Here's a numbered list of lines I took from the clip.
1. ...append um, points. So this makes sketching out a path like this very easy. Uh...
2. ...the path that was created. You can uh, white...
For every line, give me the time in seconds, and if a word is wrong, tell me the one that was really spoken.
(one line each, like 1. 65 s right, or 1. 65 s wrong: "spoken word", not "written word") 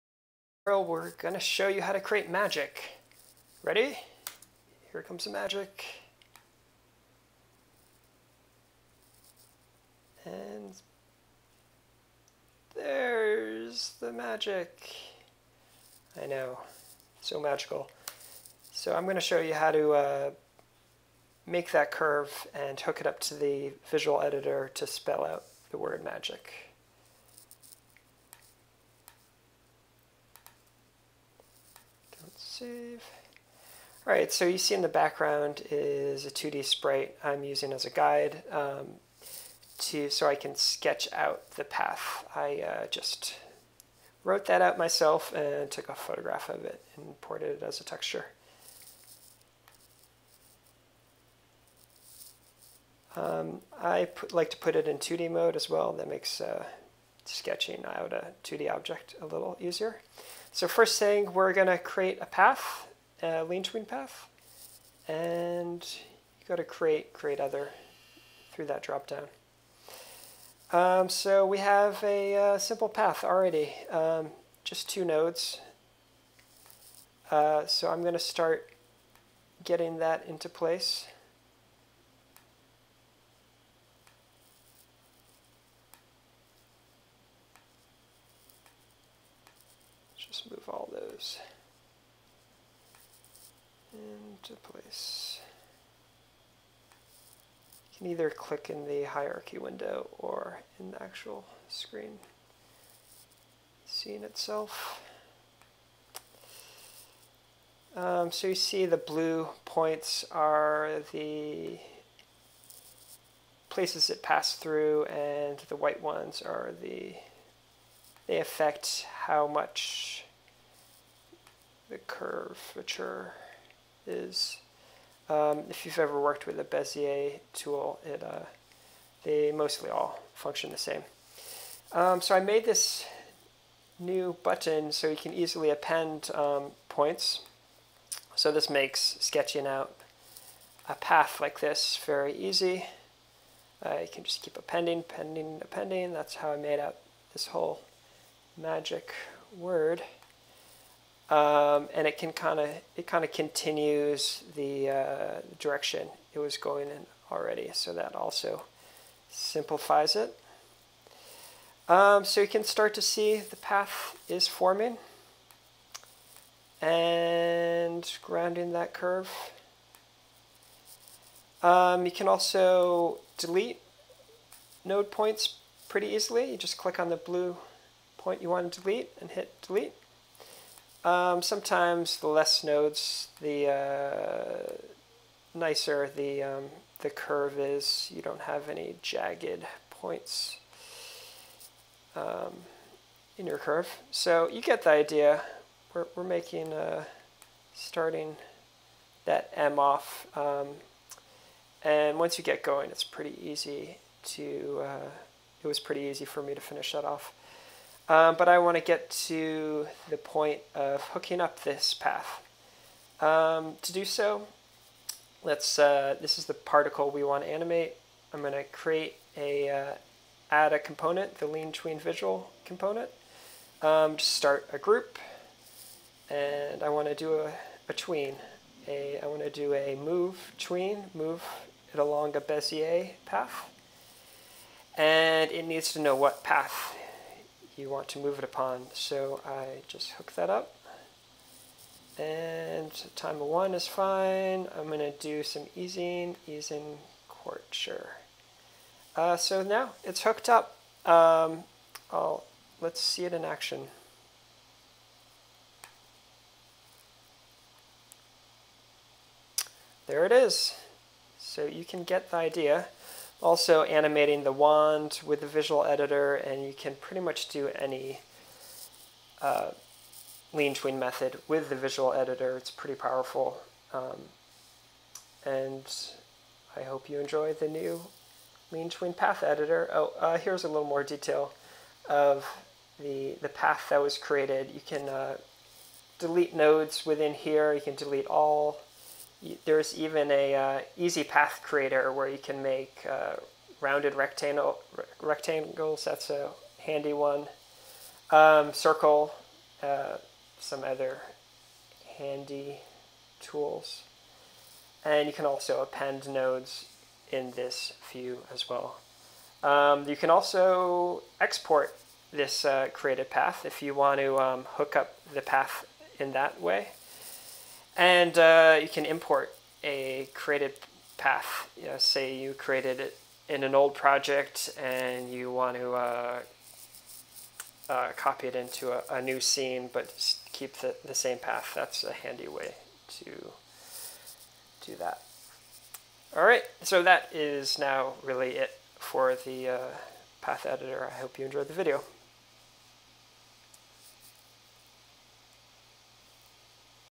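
1. 135 s right
2. 283 s wrong: "delete", not "white".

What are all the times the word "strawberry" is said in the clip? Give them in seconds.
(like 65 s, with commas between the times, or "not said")
not said.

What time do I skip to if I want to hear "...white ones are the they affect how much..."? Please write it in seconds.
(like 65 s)
115 s.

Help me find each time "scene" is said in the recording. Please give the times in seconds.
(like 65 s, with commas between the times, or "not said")
103 s, 329 s.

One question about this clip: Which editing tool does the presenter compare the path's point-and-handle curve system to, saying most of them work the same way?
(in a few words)
Bezier tool.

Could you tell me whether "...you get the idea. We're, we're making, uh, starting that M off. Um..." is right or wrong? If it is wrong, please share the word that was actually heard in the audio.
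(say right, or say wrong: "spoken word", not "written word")
right.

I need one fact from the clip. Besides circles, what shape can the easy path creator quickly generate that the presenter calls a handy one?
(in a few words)
Rounded rectangle.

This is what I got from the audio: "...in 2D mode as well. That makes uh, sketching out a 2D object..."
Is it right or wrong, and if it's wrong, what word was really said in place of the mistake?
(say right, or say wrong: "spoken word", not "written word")
right.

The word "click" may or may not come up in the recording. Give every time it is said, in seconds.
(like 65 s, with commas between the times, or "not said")
98 s, 176 s.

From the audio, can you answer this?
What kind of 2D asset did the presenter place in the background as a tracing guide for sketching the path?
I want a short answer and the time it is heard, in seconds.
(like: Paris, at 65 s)
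2D sprite, at 36 s.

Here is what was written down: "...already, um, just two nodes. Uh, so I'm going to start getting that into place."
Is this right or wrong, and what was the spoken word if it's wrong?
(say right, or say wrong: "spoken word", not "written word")
right.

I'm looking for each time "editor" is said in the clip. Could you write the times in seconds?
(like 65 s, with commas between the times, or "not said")
24 s, 265 s, 272 s, 279 s, 340 s.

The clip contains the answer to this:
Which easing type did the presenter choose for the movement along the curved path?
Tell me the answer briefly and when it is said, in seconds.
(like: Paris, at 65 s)
Easing quarter, at 246 s.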